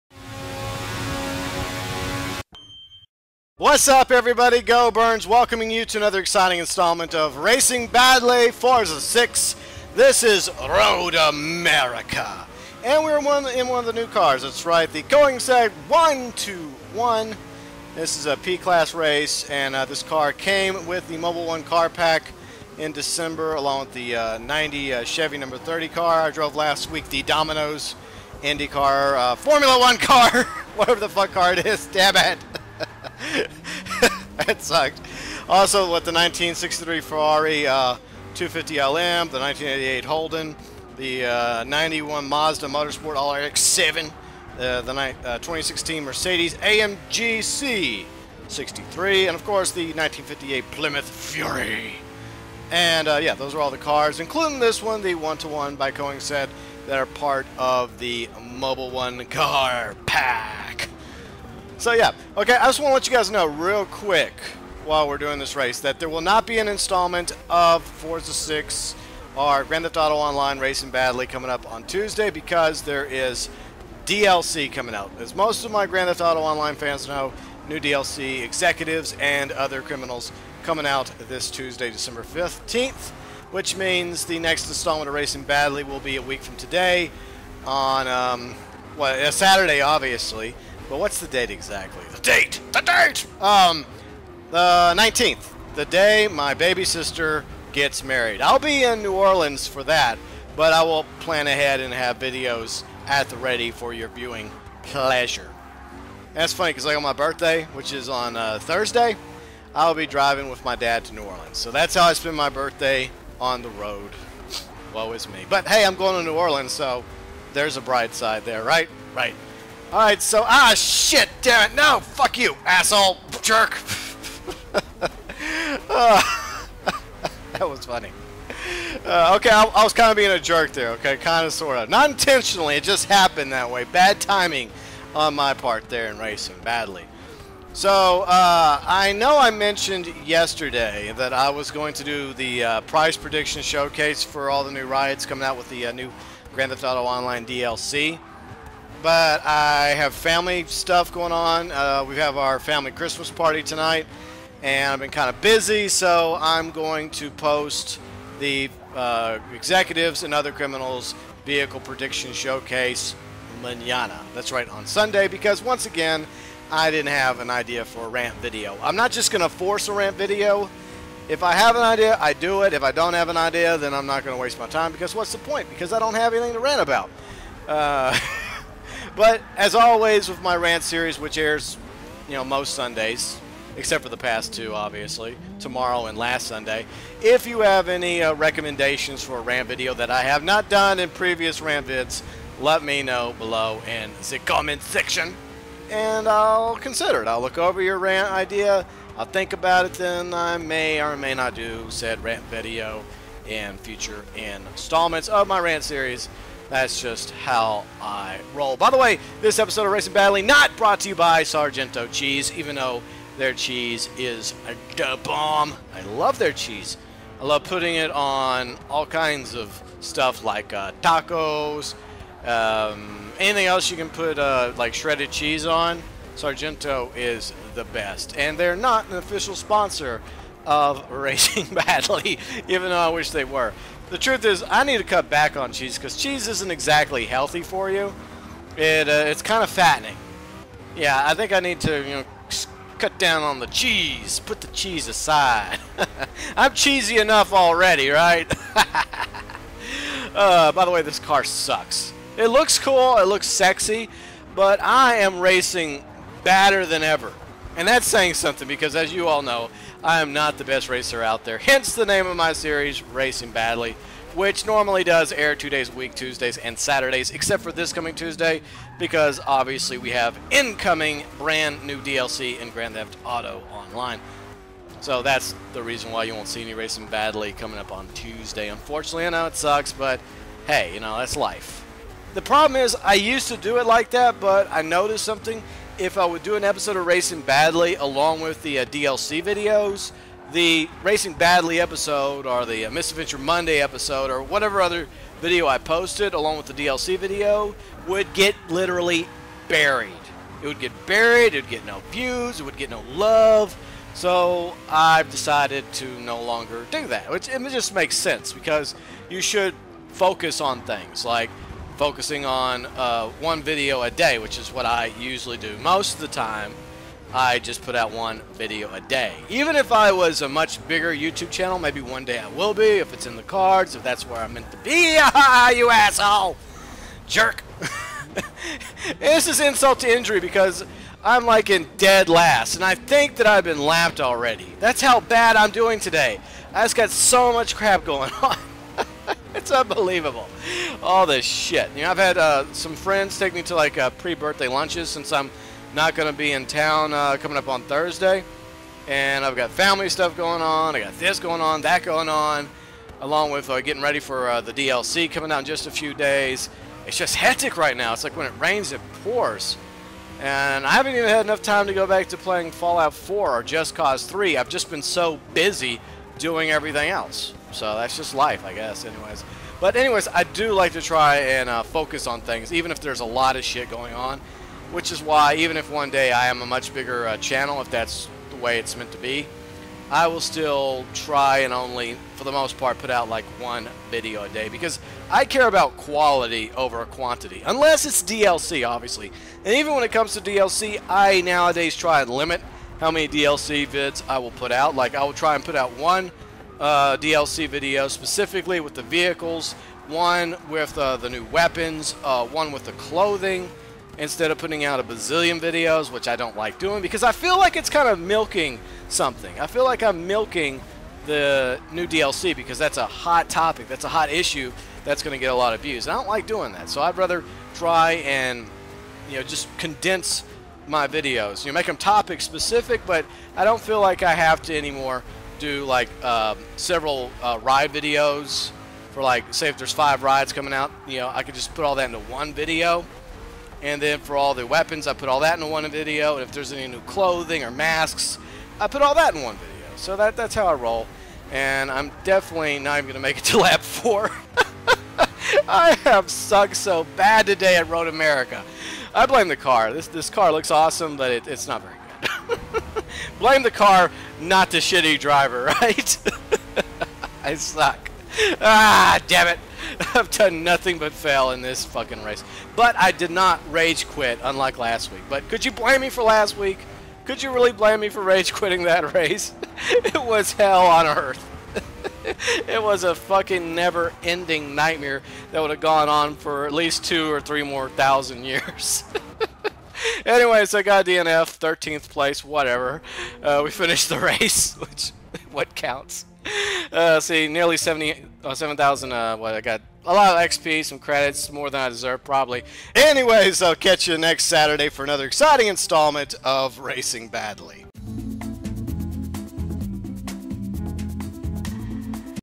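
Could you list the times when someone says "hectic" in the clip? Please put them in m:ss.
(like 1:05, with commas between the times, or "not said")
5:57.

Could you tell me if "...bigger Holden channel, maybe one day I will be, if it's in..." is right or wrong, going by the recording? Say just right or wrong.
wrong.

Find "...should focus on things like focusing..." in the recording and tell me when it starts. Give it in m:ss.
5:09.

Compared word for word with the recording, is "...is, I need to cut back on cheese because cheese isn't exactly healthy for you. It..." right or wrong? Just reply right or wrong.
right.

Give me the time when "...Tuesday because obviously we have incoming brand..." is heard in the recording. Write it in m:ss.
4:28.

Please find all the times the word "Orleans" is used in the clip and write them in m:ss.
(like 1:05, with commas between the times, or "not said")
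1:39, 1:51, 1:56.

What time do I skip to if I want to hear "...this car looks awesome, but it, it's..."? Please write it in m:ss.
7:30.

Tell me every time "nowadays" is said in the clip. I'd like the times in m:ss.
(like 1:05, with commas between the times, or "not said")
6:31.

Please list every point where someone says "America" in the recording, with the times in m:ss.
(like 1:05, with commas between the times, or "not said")
0:11, 7:28.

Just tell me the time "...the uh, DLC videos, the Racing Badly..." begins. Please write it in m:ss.
4:48.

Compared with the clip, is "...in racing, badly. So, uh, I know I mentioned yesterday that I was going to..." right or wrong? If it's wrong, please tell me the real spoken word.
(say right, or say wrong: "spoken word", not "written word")
right.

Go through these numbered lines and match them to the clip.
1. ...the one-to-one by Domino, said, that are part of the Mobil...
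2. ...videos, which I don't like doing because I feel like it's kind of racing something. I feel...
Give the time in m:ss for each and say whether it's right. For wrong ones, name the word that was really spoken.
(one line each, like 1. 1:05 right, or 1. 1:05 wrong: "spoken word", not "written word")
1. 0:55 wrong: "Koenigsegg", not "Domino"
2. 6:45 wrong: "milking", not "racing".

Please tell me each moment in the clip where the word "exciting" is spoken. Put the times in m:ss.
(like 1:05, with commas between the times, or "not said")
0:06, 8:15.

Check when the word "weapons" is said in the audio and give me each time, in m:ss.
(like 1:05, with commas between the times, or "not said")
6:41, 7:14.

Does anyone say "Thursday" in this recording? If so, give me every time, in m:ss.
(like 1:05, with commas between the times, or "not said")
1:48, 5:47.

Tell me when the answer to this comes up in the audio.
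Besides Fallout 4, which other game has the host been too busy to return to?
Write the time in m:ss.
6:03.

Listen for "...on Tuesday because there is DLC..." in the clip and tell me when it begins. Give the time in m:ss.
1:11.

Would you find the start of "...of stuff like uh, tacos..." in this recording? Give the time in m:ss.
3:39.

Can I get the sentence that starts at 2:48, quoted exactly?
I'm not just going to force a rant video.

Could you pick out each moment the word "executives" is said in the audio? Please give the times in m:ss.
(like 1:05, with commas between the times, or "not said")
1:18, 2:39.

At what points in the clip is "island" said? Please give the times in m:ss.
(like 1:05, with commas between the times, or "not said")
not said.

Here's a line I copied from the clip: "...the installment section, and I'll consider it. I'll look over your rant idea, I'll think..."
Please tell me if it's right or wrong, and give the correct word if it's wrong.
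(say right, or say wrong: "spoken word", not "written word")
wrong: "comment", not "installment".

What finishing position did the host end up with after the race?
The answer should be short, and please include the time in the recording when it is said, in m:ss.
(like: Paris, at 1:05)
13th, at 8:01.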